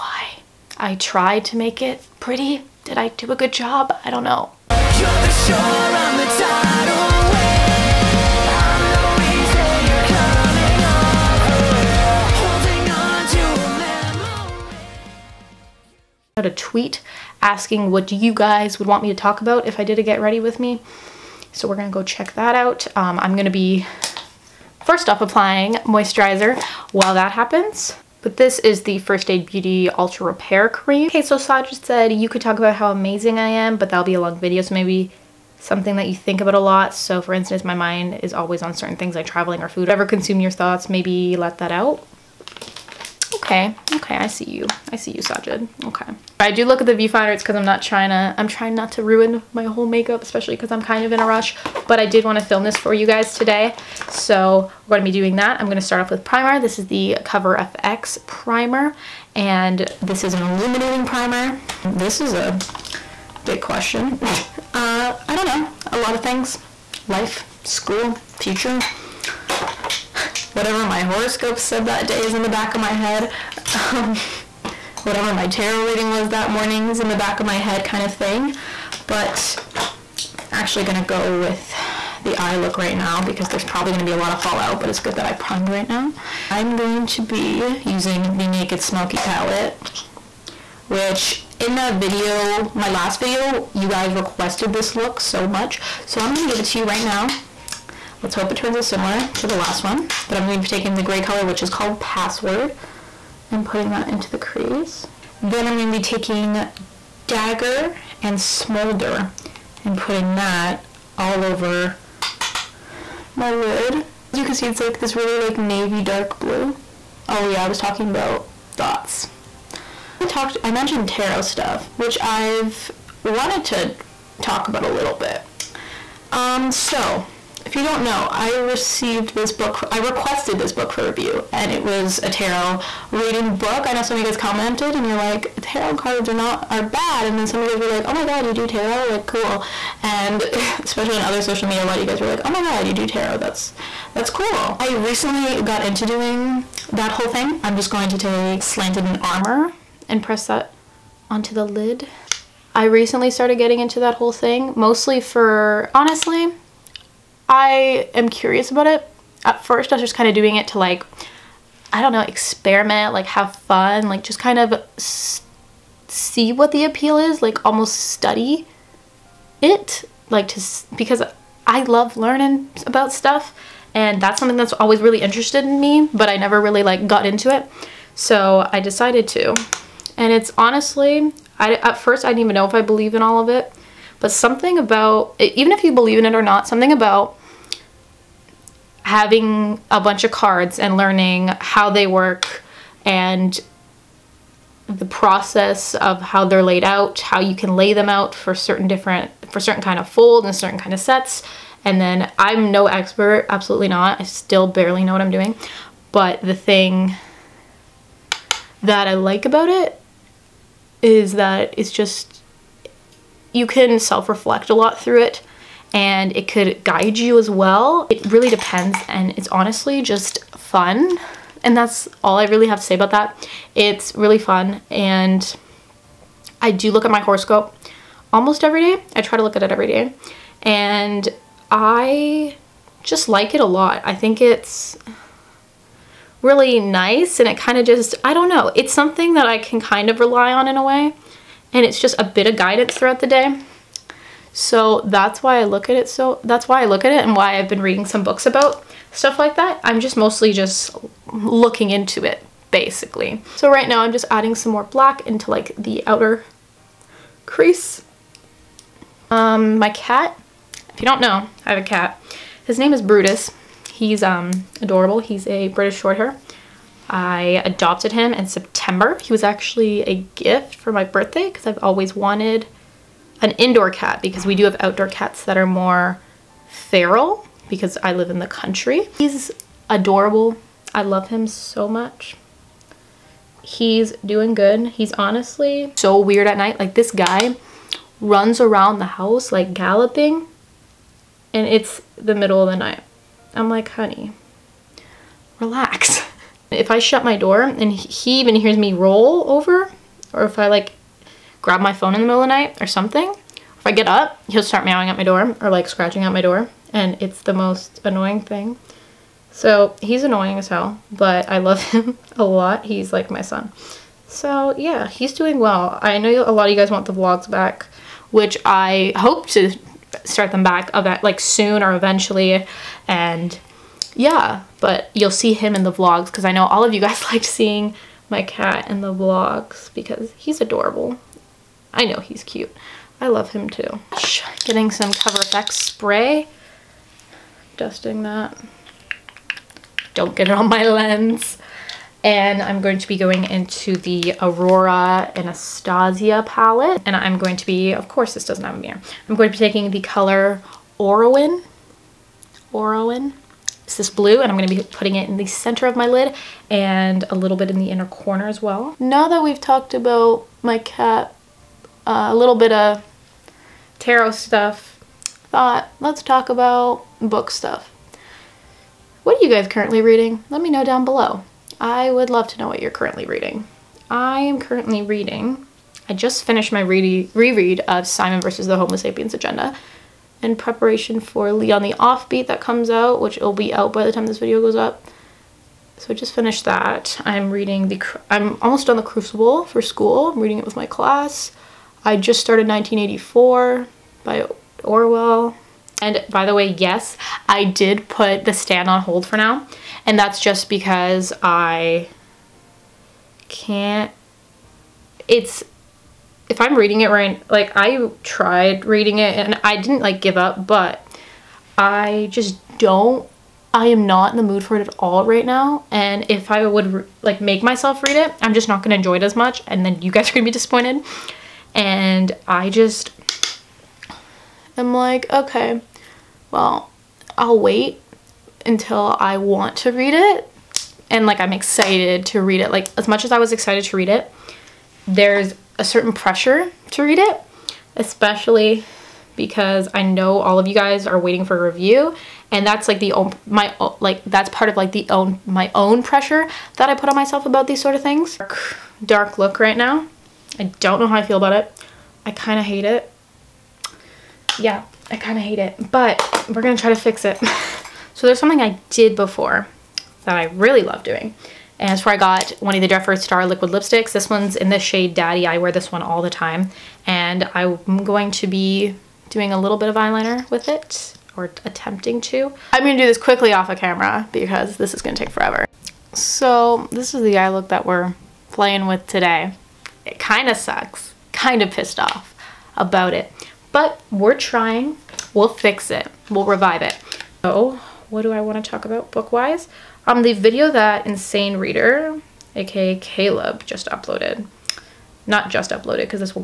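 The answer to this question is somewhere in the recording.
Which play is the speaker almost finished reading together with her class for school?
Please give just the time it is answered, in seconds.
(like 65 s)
389 s.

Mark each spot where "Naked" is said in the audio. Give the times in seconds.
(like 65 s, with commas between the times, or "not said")
88 s.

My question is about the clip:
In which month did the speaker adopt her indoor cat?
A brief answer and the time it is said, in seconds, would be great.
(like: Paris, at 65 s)
September, at 268 s.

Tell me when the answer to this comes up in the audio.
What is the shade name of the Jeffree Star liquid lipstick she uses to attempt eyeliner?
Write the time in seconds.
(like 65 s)
465 s.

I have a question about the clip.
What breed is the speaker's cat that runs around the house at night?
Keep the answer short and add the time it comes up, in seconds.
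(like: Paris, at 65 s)
British Shorthair, at 265 s.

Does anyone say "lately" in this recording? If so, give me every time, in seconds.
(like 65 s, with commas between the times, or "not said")
not said.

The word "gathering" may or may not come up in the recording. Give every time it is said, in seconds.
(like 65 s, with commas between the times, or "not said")
not said.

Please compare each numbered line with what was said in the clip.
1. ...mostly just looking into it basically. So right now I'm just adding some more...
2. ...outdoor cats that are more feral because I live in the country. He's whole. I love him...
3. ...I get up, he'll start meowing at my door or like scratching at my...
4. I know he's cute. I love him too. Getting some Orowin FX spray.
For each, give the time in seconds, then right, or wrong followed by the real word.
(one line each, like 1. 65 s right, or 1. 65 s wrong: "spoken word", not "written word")
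1. 250 s right
2. 274 s wrong: "adorable", not "whole"
3. 303 s right
4. 331 s wrong: "Cover", not "Orowin".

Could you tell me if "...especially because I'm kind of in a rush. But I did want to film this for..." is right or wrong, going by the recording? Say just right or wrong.
right.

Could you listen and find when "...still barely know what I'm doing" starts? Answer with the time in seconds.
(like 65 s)
204 s.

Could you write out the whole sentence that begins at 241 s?
And it's just a bit of guidance throughout the day.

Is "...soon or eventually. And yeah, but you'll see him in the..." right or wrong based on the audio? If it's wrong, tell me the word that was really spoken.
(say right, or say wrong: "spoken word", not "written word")
right.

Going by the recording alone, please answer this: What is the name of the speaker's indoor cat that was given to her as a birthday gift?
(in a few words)
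Brutus.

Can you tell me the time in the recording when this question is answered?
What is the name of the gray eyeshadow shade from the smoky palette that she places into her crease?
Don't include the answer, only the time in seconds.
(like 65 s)
102 s.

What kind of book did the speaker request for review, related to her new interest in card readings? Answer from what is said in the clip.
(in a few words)
tarot reading book.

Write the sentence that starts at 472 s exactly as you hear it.
I'm gonna do this quickly off a of camera because this is gonna take forever.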